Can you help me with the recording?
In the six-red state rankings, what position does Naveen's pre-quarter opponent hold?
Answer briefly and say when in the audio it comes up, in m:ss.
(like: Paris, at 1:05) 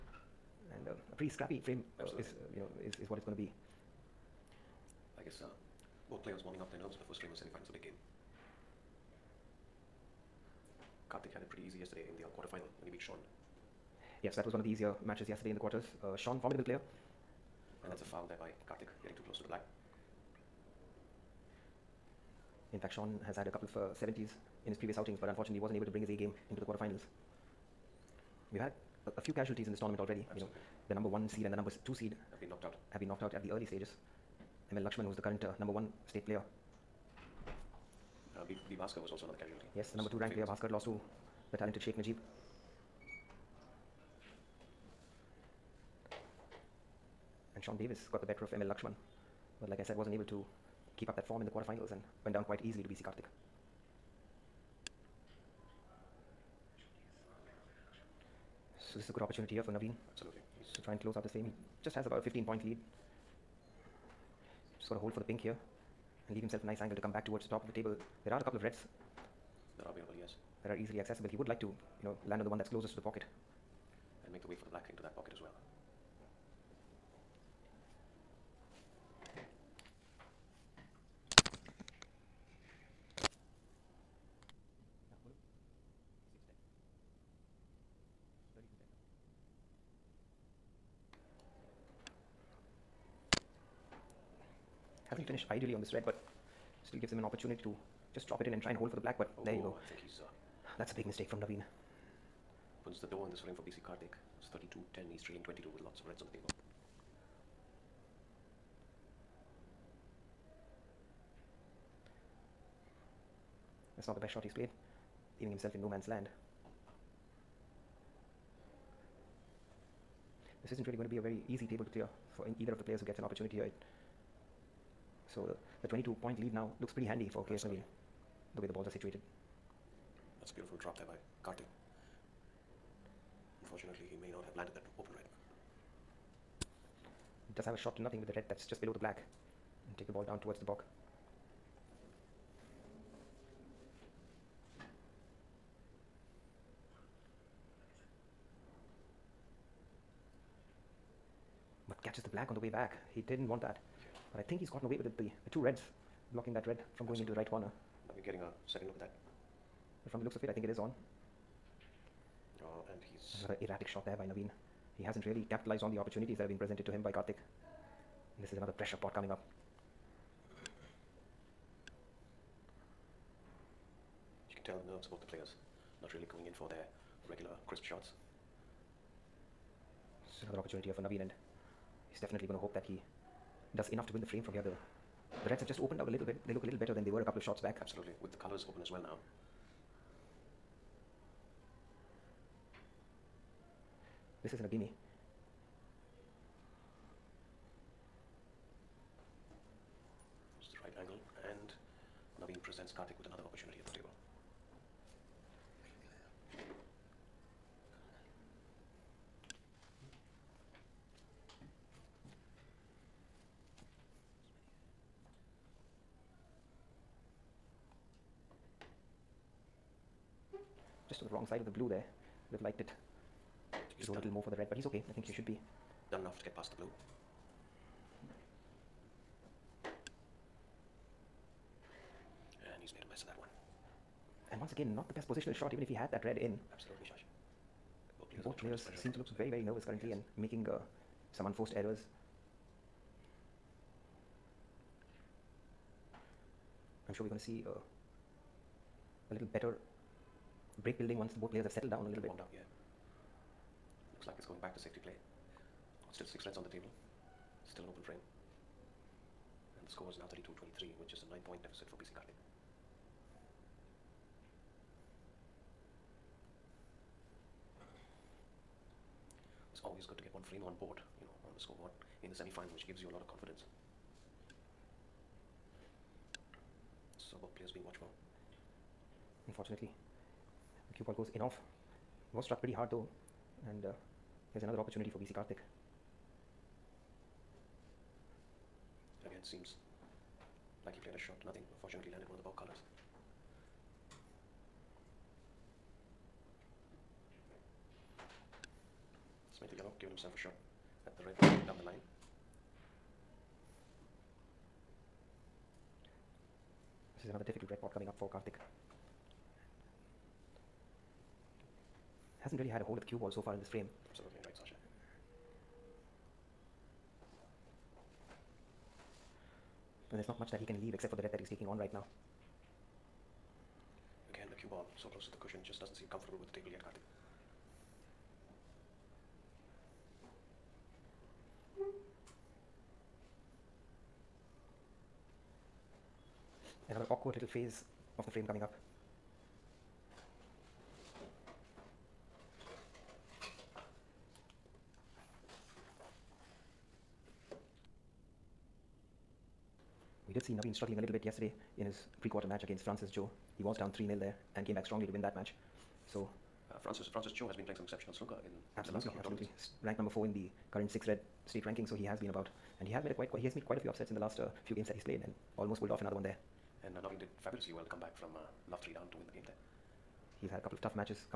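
4, at 5:59.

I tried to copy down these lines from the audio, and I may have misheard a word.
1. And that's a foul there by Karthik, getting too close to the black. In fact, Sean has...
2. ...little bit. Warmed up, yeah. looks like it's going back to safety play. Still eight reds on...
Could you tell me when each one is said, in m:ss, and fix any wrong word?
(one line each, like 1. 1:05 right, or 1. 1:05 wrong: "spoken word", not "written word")
1. 0:17 right
2. 4:12 wrong: "six", not "eight".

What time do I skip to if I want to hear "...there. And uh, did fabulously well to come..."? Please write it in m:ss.
6:06.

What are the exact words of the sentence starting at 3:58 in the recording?
both players seem to look very, very nervous currently yes.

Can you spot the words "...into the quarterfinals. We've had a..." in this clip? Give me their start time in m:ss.
0:26.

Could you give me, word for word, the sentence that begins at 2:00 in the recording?
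This isn't really going to be a very easy table to clear for either of the players who gets an opportunity here.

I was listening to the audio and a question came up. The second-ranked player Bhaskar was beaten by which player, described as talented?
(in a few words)
Sheikh Najib.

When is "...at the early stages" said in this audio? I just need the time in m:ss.
0:33.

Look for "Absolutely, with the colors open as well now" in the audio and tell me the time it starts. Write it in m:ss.
3:07.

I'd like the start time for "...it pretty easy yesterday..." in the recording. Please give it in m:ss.
0:11.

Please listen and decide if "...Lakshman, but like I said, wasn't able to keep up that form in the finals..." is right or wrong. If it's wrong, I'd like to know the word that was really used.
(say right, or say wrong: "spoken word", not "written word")
wrong: "quarterfinals", not "finals".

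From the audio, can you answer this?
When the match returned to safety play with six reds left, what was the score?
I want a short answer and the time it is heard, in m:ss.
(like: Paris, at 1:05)
32-23, at 4:20.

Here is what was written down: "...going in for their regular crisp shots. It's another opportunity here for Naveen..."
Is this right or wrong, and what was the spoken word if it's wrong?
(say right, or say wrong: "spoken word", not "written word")
right.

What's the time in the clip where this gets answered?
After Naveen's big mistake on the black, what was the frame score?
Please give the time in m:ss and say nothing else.
1:44.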